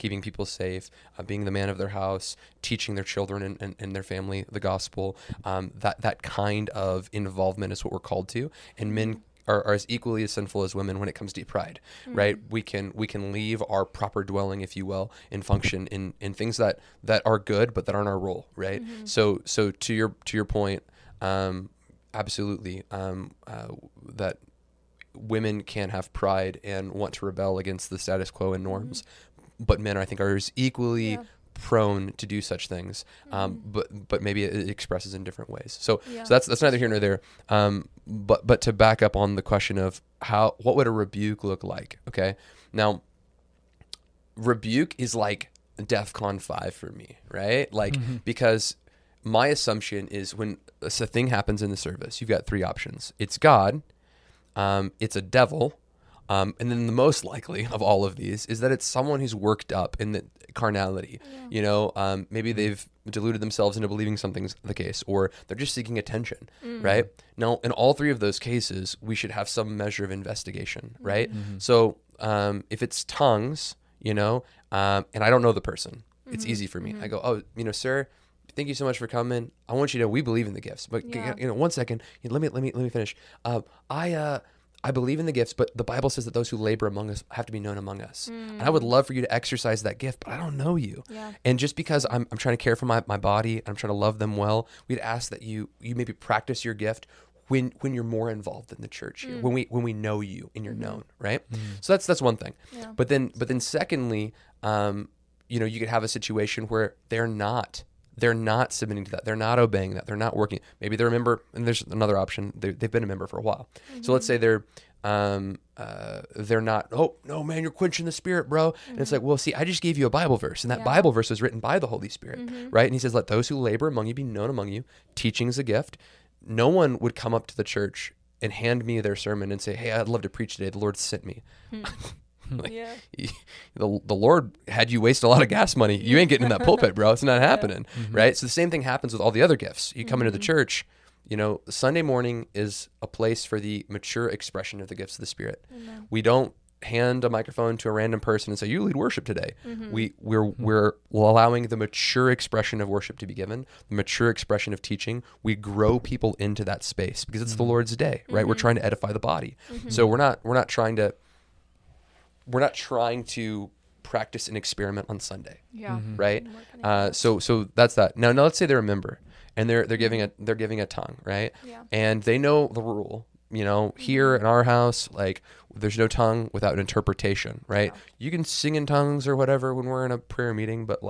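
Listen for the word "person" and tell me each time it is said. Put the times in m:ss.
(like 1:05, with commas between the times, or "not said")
1:15, 2:28.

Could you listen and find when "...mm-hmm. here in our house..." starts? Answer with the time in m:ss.
2:53.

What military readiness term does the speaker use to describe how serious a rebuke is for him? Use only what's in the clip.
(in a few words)
DefCon five.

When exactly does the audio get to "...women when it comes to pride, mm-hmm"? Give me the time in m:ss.
0:10.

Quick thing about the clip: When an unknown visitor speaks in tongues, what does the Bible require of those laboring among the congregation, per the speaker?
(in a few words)
Be known among us.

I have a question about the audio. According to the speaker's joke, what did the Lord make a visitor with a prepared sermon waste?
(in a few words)
Gas money.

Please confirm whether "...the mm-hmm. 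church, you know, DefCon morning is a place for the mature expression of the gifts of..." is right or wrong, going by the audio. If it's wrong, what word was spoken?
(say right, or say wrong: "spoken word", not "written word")
wrong: "Sunday", not "DefCon".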